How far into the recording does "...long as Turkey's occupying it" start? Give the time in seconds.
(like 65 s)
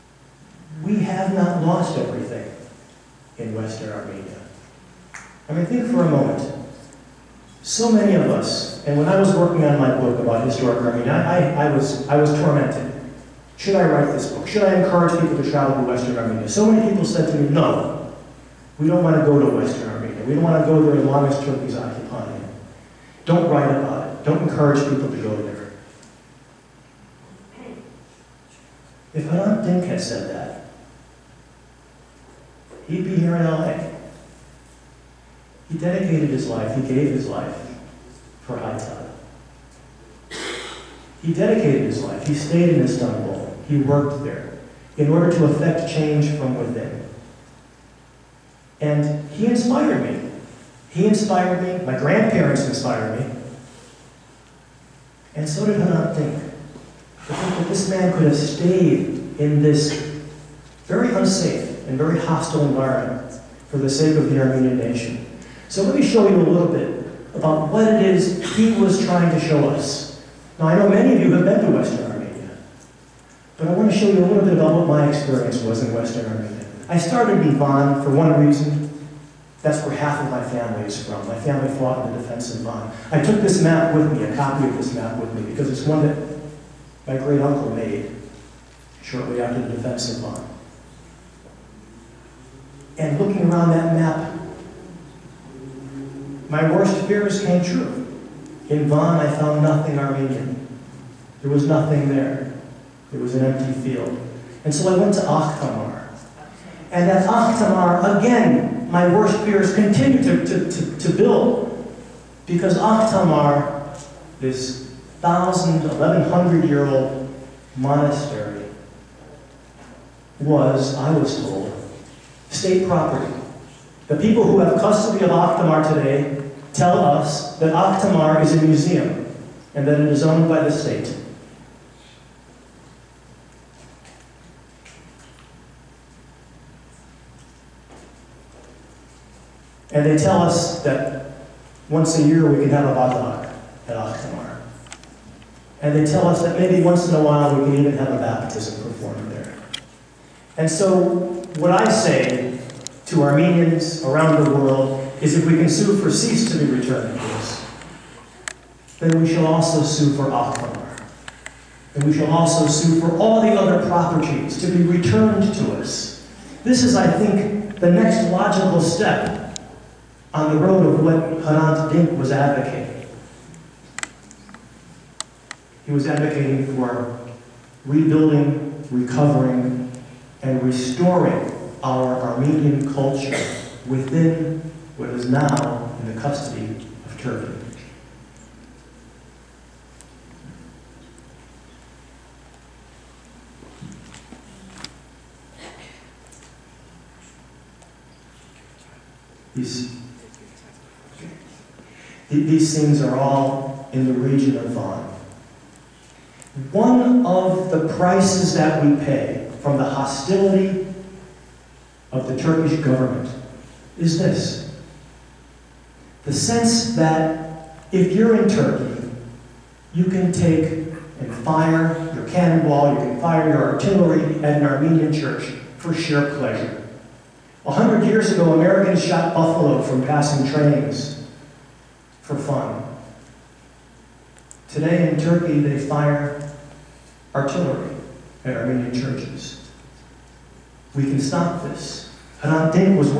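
21 s.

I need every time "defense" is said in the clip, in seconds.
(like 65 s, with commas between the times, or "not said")
82 s, 89 s.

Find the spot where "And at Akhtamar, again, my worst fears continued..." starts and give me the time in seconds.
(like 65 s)
106 s.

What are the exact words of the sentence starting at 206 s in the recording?
One of the prices that we pay from the hostility of the Turkish government is this.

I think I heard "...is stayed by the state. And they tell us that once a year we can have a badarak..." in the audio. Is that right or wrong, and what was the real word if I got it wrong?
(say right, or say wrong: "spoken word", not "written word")
wrong: "owned", not "stayed".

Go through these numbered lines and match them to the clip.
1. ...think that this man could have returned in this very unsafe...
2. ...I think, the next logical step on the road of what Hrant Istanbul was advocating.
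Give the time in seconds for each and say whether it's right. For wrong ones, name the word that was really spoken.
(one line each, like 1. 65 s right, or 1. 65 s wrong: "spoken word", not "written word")
1. 57 s wrong: "stayed", not "returned"
2. 166 s wrong: "Dink", not "Istanbul".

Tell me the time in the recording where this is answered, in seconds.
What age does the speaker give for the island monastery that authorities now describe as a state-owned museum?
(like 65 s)
115 s.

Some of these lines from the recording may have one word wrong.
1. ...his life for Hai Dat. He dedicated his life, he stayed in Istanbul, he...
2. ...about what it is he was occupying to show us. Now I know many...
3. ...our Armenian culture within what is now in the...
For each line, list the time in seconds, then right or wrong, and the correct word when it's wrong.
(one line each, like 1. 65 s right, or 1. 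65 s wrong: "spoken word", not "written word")
1. 37 s right
2. 67 s wrong: "trying", not "occupying"
3. 181 s right.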